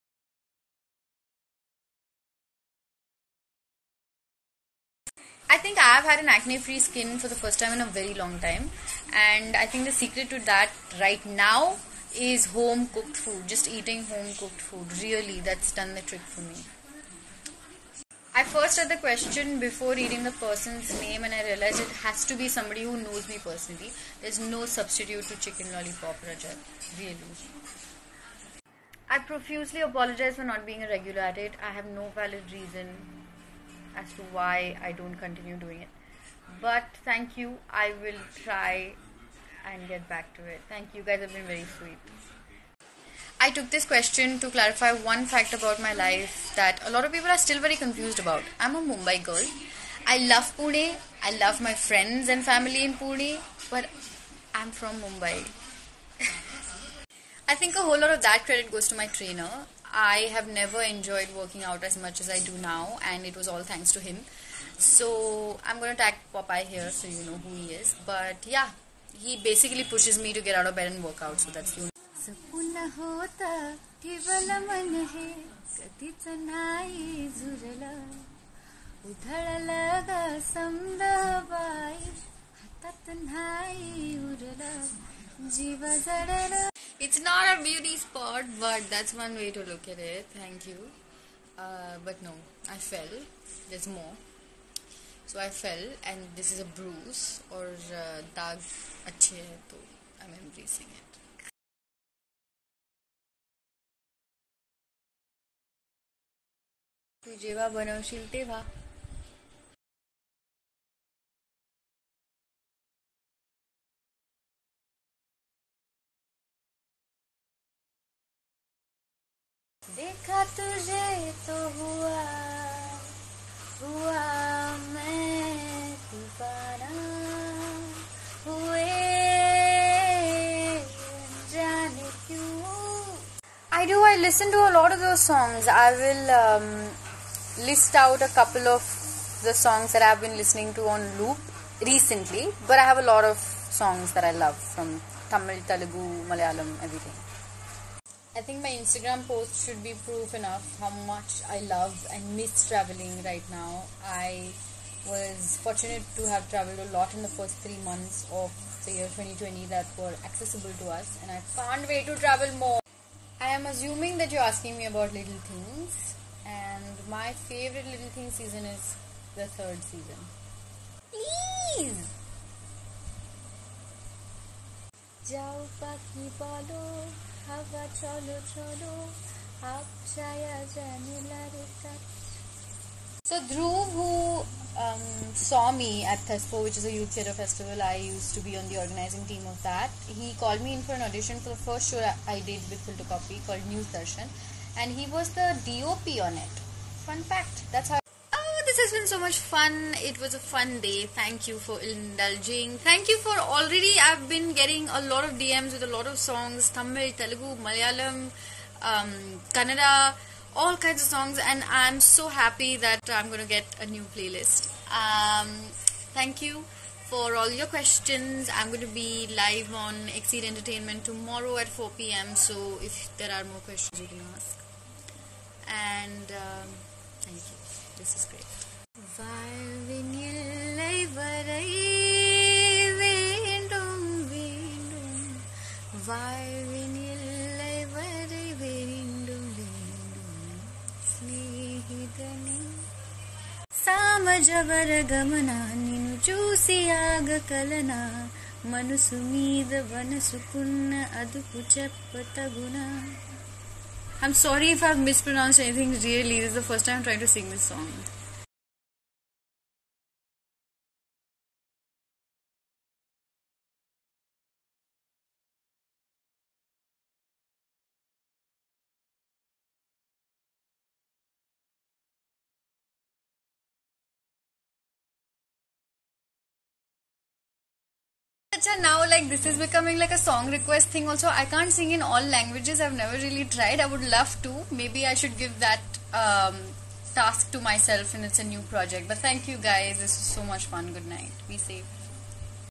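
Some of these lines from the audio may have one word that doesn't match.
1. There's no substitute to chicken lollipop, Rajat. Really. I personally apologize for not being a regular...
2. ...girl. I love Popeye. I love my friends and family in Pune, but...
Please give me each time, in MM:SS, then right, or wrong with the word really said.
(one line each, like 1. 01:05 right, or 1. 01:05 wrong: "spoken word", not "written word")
1. 00:24 wrong: "profusely", not "personally"
2. 00:49 wrong: "Pune", not "Popeye".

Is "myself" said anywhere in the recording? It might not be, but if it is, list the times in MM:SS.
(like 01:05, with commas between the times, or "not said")
04:47.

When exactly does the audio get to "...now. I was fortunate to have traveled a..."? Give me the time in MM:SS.
02:33.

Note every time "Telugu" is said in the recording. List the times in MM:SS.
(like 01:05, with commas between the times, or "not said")
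02:25, 03:27.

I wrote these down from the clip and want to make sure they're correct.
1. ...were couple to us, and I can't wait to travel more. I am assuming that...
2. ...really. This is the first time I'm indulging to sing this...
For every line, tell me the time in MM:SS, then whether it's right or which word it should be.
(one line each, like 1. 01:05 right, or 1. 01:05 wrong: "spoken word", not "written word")
1. 02:39 wrong: "accessible", not "couple"
2. 04:16 wrong: "trying", not "indulging".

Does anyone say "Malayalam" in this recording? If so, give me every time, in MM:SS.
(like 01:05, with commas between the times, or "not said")
02:26, 03:27.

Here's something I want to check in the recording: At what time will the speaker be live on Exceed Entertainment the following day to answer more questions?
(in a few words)
4 pm.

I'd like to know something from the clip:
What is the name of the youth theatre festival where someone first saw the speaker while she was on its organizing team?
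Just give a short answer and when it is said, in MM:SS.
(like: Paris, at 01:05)
Thespo, at 03:06.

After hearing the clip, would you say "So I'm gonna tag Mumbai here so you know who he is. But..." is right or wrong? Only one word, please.
wrong.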